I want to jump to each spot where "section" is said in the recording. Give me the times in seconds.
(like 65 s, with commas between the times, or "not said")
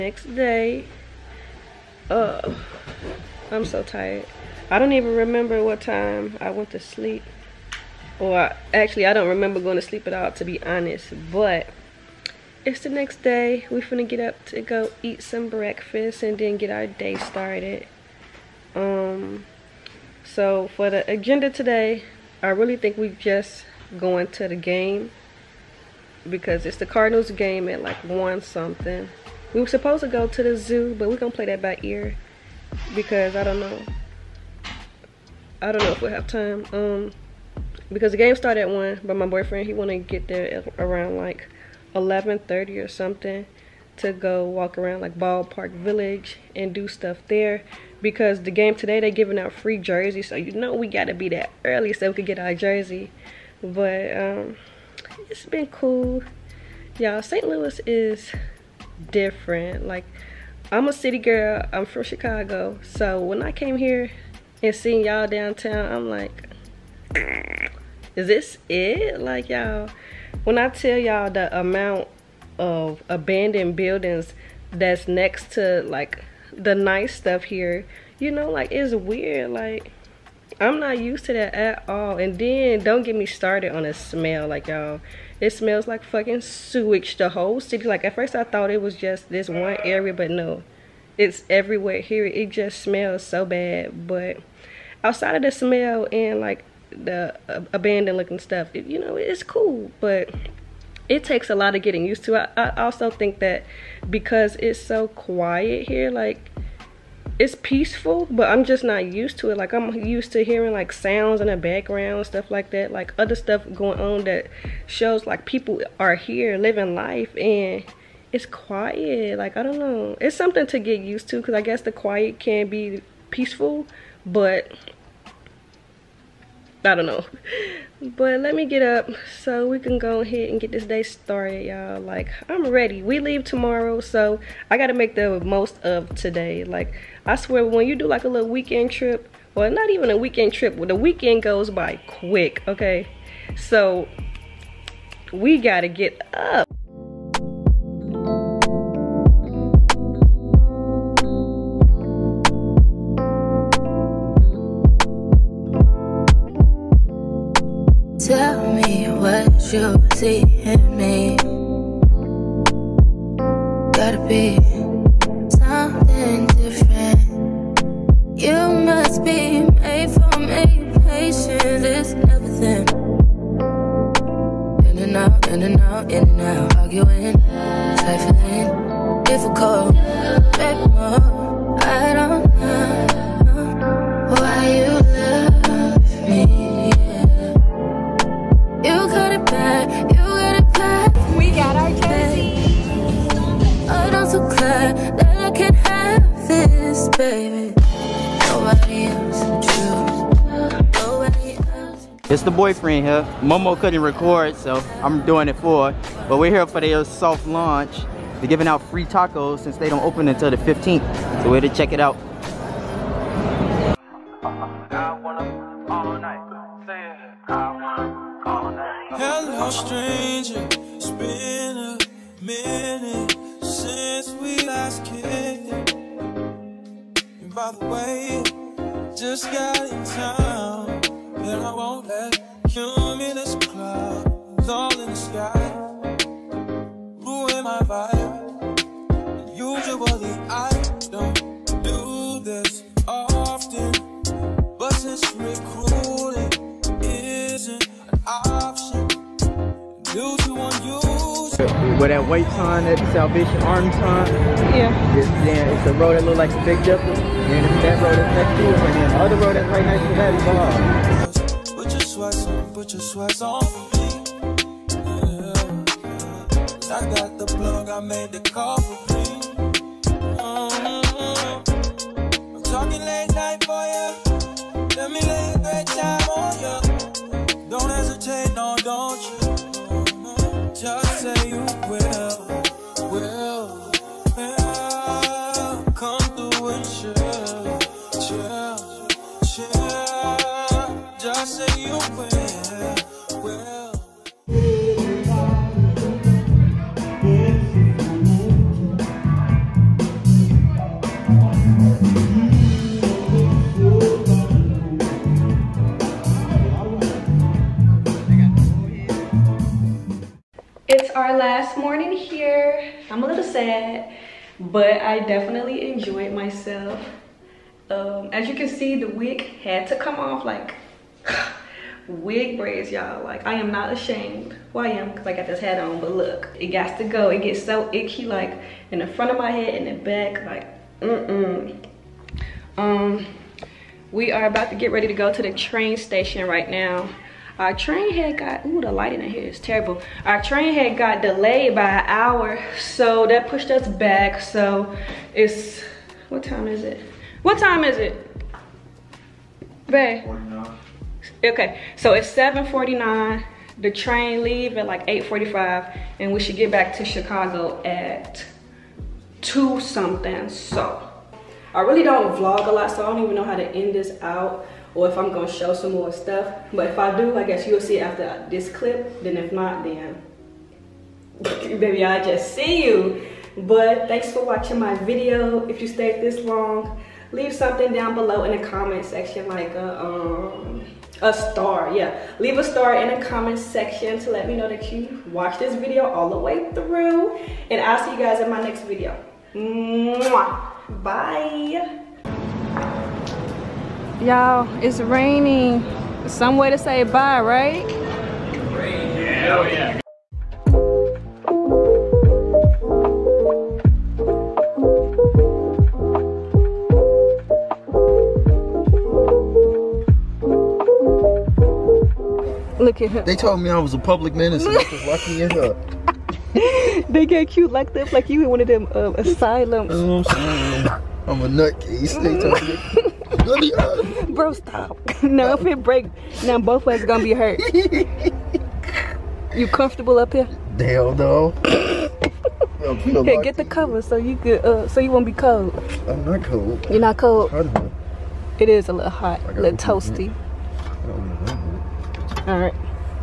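379 s, 383 s.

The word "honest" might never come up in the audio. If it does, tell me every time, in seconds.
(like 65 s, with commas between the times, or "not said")
10 s.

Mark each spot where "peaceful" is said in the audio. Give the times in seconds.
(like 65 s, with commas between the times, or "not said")
107 s, 123 s.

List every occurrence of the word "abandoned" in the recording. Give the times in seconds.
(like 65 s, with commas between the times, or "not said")
73 s, 97 s.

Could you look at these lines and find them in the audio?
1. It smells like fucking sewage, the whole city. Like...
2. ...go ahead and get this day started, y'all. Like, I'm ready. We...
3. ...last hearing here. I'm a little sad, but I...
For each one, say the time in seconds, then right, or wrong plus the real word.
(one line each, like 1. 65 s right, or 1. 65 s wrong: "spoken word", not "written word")
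1. 85 s right
2. 129 s right
3. 311 s wrong: "morning", not "hearing".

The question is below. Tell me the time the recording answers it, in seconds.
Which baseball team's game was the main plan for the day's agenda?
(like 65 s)
26 s.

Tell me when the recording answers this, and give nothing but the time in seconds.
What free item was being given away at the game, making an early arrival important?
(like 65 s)
49 s.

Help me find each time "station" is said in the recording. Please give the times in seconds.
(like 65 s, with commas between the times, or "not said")
335 s.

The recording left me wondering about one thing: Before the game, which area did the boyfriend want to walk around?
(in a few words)
Ballpark Village.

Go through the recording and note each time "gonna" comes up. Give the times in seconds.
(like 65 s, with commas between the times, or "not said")
13 s, 31 s, 365 s, 427 s.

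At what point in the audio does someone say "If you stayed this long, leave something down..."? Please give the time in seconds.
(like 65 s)
375 s.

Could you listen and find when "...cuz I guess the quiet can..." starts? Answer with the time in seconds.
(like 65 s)
121 s.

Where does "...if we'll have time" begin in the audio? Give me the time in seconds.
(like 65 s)
35 s.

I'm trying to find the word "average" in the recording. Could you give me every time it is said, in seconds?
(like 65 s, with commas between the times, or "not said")
not said.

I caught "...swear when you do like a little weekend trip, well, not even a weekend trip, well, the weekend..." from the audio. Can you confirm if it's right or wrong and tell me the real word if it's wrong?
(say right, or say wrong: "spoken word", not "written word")
right.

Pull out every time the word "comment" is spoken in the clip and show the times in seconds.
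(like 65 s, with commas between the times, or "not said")
378 s, 383 s.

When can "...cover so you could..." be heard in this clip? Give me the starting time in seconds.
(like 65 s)
433 s.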